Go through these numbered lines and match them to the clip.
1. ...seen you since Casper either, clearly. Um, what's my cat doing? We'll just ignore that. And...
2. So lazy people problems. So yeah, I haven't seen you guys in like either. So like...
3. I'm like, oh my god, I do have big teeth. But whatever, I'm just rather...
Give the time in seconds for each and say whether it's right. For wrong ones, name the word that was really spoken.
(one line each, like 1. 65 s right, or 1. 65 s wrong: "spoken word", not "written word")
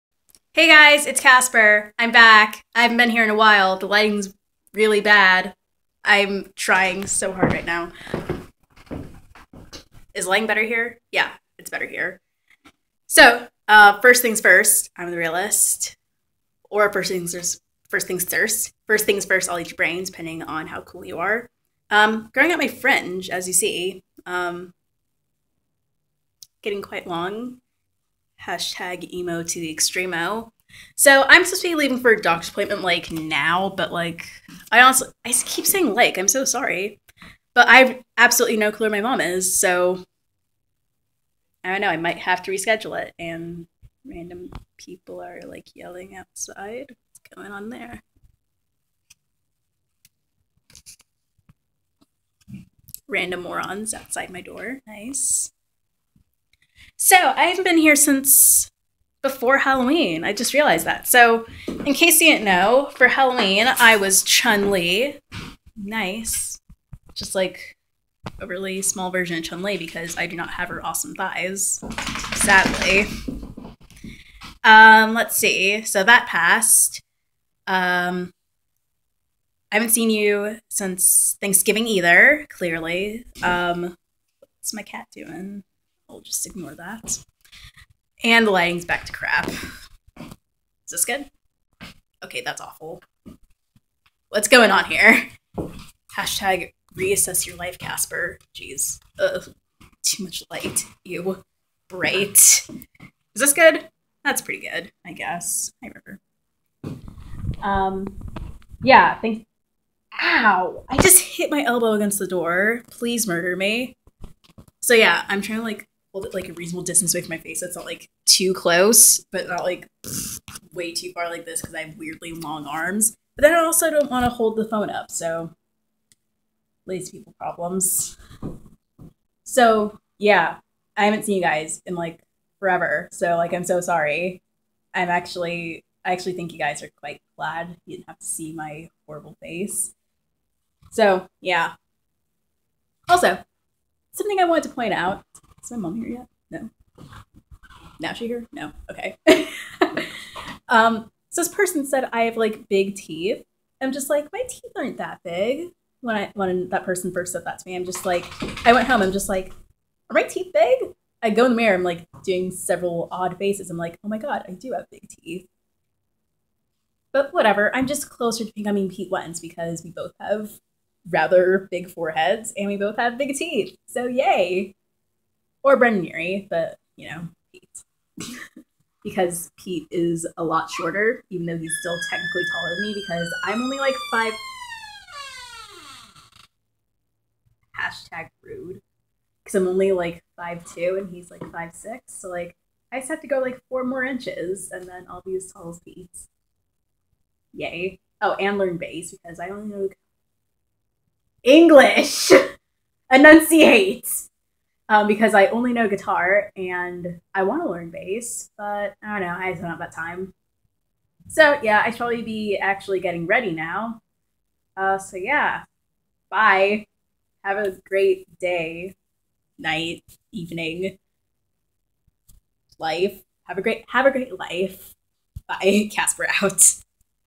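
1. 79 s wrong: "Thanksgiving", not "Casper"
2. 125 s wrong: "forever", not "either"
3. 163 s wrong: "closer", not "rather".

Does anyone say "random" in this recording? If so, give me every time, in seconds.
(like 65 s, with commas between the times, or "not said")
44 s, 53 s.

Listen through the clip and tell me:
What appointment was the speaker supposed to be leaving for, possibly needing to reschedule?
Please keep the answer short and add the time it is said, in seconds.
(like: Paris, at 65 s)
Doctor's appointment, at 32 s.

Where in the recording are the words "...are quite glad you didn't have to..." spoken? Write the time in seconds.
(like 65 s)
136 s.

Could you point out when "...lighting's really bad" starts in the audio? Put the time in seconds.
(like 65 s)
3 s.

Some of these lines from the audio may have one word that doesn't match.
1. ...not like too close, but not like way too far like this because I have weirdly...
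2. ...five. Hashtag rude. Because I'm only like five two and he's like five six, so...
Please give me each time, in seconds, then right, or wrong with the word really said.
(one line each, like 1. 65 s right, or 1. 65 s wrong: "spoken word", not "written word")
1. 117 s right
2. 184 s right.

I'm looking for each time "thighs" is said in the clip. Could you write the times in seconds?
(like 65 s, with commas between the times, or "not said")
71 s.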